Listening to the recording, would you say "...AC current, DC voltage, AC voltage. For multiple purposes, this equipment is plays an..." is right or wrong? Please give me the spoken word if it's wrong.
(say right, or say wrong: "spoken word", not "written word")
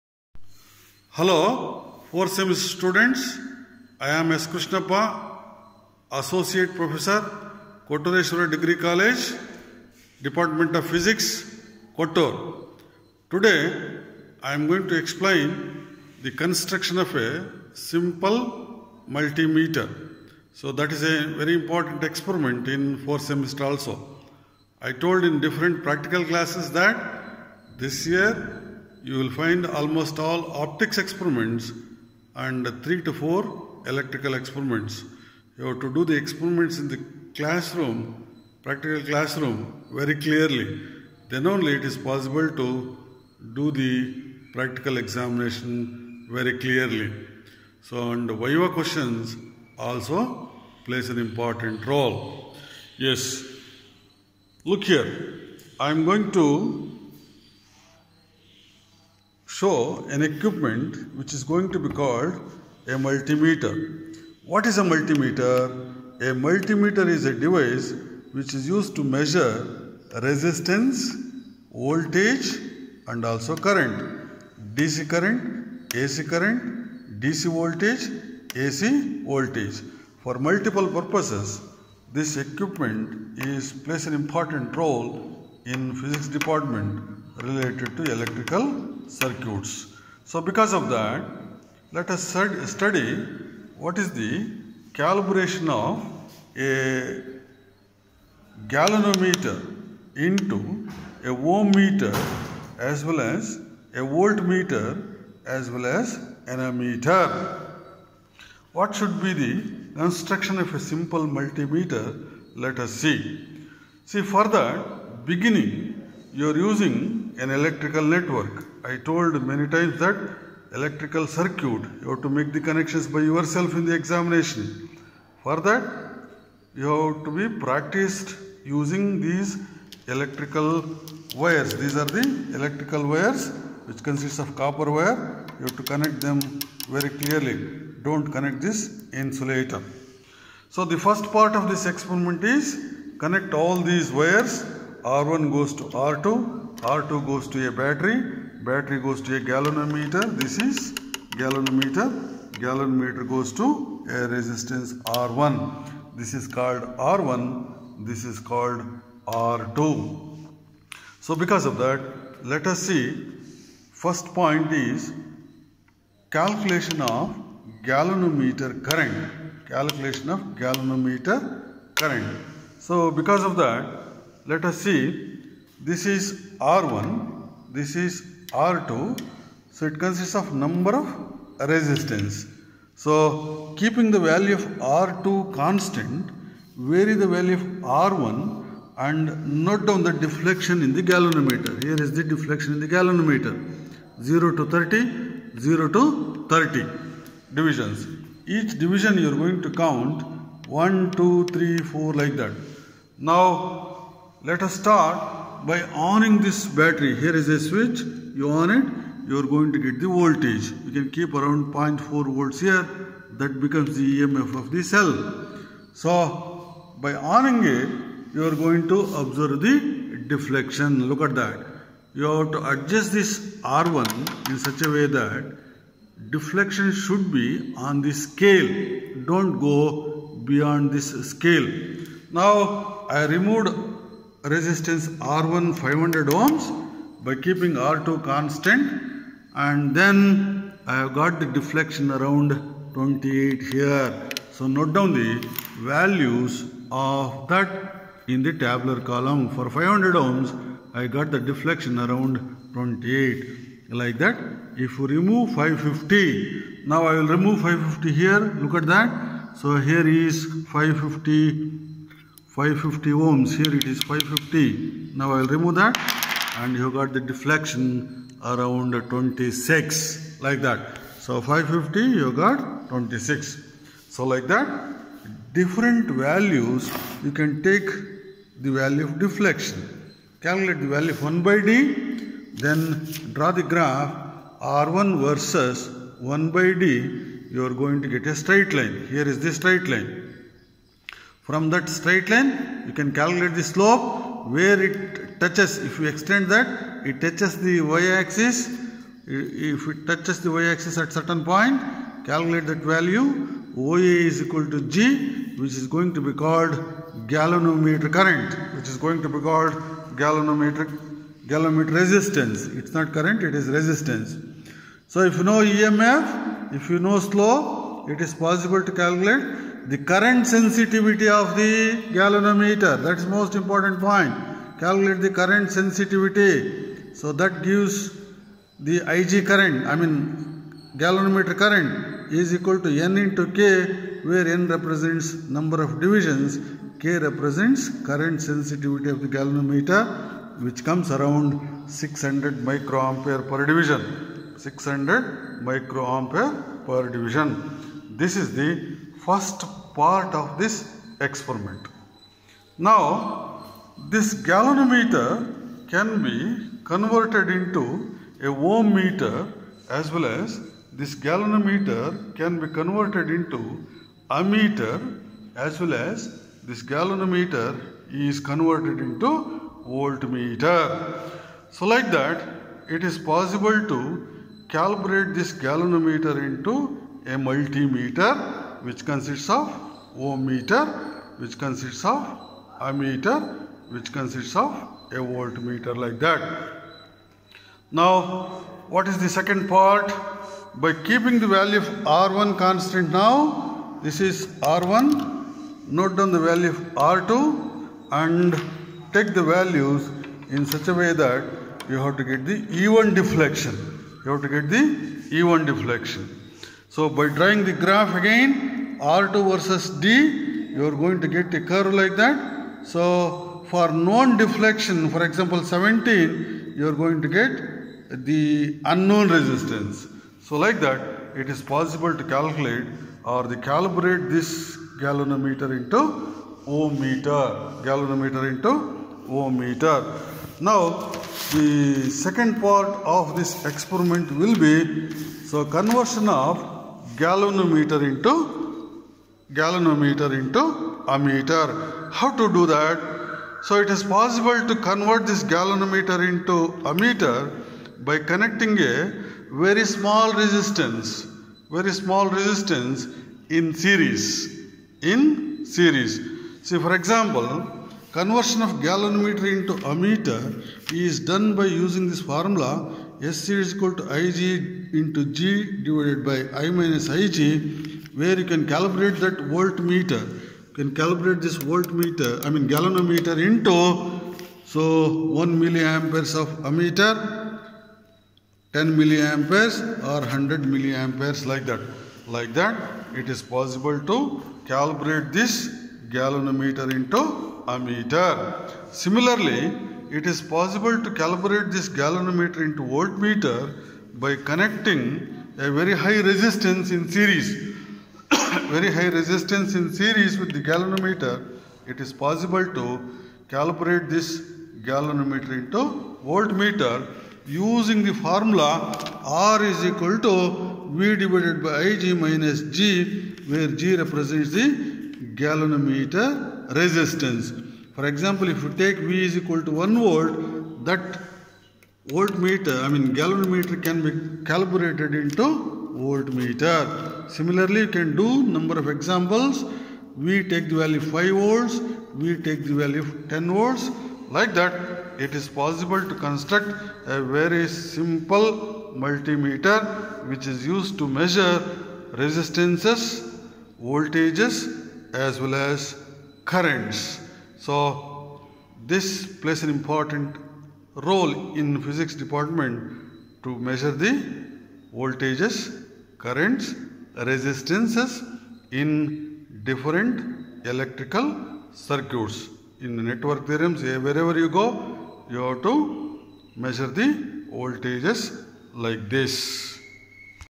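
right.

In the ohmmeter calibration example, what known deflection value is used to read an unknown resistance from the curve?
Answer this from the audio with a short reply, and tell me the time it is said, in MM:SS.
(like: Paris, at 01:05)
17, at 06:55.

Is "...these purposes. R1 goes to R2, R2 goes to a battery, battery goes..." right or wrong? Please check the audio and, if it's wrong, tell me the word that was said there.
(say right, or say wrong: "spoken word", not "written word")
wrong: "wires", not "purposes".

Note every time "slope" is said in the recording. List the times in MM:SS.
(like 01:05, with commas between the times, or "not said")
04:53, 05:17.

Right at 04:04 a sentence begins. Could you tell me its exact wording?
So note down the values of that in the tabular column.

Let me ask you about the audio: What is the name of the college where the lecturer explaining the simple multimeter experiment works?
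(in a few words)
Kottureshwara Degree College.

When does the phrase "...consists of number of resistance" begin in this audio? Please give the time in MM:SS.
02:59.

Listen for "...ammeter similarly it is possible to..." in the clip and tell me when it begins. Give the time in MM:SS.
08:07.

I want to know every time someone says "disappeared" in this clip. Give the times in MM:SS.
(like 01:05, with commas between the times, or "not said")
not said.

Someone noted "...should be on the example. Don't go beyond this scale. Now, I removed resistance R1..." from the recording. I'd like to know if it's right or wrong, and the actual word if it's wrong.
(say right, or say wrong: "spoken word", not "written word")
wrong: "scale", not "example".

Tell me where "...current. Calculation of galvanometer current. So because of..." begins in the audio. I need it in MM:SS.
02:48.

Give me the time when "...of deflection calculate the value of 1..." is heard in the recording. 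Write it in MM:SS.
04:39.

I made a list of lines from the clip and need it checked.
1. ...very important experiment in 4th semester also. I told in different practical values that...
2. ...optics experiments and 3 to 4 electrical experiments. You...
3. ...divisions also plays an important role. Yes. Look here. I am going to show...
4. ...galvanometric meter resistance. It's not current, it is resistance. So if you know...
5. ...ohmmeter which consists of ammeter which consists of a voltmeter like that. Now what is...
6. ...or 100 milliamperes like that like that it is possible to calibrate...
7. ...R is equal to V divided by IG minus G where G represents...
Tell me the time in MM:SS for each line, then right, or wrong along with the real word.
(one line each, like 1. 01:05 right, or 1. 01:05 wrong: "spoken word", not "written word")
1. 00:21 wrong: "classes", not "values"
2. 00:30 right
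3. 00:48 wrong: "questions", not "divisions"
4. 05:10 wrong: "galvanometer", not "meter"
5. 06:20 right
6. 08:00 right
7. 08:29 right.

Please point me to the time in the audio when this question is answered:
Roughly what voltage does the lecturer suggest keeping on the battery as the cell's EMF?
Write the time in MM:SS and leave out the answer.
03:31.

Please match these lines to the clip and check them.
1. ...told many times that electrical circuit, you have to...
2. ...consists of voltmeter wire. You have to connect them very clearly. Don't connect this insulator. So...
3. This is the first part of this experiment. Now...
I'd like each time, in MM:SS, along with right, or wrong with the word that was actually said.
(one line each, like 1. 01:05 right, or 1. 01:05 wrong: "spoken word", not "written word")
1. 01:58 right
2. 02:14 wrong: "copper", not "voltmeter"
3. 05:48 right.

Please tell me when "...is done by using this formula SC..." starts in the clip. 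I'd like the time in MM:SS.
07:40.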